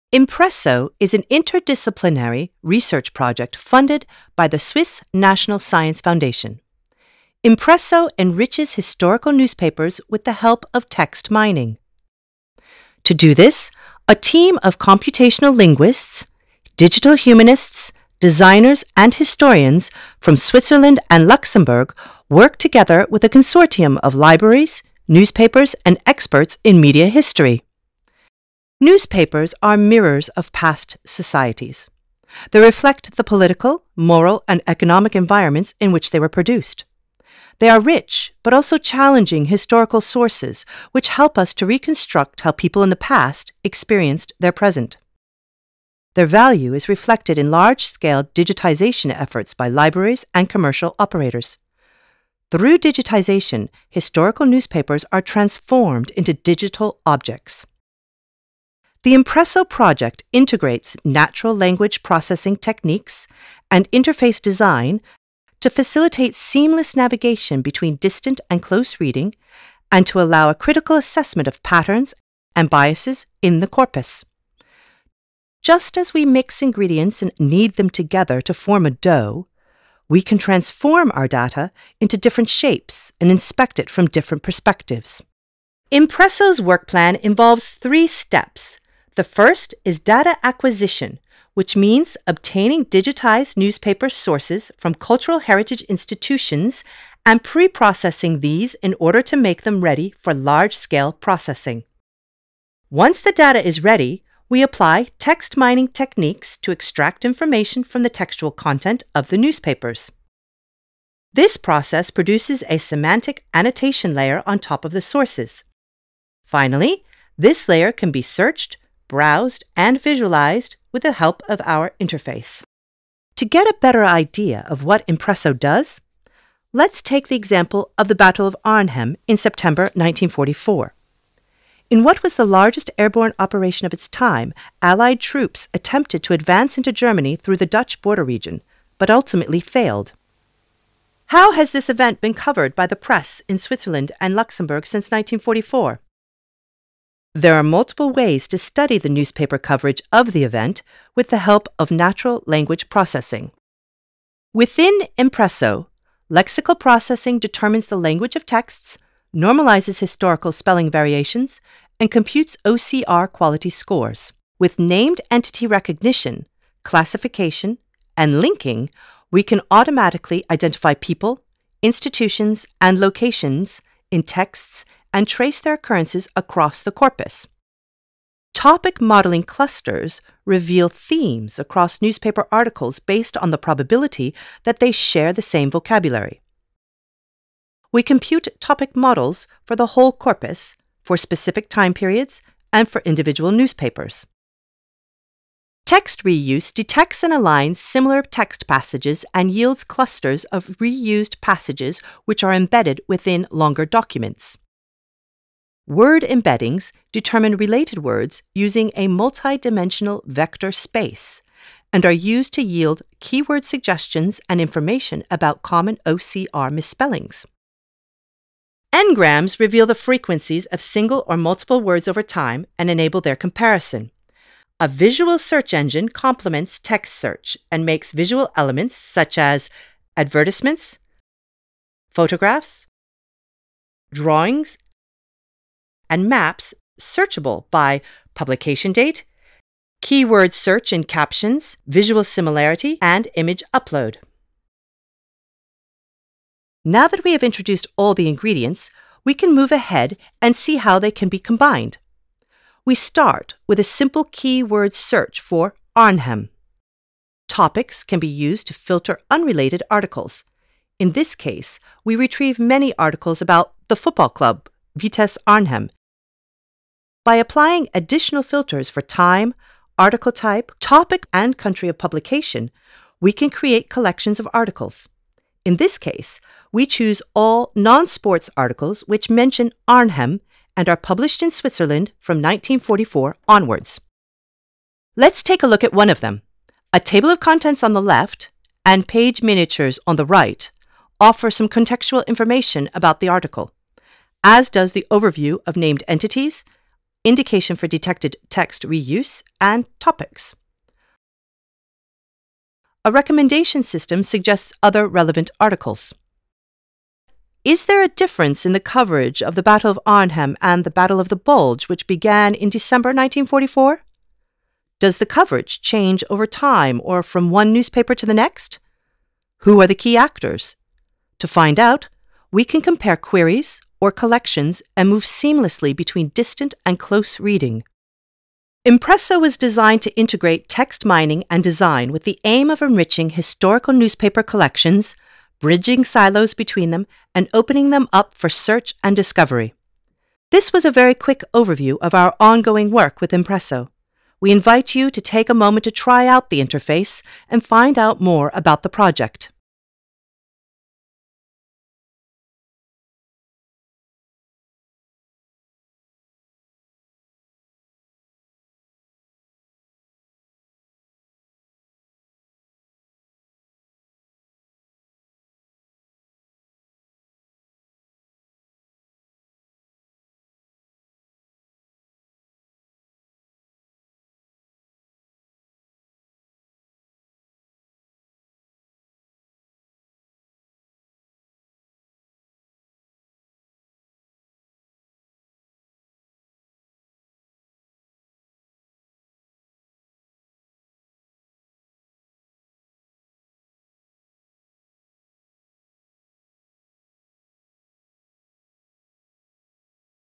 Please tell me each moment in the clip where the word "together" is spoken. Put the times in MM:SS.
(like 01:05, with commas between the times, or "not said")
00:22, 01:17.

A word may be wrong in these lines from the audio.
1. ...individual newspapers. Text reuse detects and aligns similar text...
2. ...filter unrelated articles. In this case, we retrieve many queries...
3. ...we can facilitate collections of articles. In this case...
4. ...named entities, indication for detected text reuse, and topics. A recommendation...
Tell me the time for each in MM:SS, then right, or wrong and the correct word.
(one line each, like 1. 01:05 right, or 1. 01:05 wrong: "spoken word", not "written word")
1. 03:13 right
2. 04:18 wrong: "articles", not "queries"
3. 04:33 wrong: "create", not "facilitate"
4. 04:55 right.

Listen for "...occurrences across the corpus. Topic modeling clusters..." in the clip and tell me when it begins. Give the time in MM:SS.
02:55.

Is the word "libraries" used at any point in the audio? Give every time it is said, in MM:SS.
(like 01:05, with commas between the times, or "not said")
00:24, 00:49.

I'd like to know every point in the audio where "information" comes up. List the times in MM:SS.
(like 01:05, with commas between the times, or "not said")
01:47, 03:34, 04:52.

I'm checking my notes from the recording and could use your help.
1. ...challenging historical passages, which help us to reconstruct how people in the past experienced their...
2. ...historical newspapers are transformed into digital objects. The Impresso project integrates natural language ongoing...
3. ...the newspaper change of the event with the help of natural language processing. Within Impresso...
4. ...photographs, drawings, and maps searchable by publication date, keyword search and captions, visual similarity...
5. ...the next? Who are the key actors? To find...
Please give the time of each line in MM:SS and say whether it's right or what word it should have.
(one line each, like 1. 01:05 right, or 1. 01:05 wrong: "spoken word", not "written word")
1. 00:38 wrong: "sources", not "passages"
2. 00:53 wrong: "processing", not "ongoing"
3. 02:28 wrong: "coverage", not "change"
4. 03:52 right
5. 05:18 right.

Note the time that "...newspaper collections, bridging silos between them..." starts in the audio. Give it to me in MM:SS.
05:33.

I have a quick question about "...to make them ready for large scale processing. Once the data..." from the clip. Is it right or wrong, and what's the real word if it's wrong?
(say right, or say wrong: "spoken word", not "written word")
right.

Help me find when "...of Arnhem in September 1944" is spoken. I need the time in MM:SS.
02:08.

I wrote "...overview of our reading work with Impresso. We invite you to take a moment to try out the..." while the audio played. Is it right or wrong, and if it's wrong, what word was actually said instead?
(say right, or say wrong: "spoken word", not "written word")
wrong: "ongoing", not "reading".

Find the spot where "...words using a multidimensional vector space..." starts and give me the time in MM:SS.
03:27.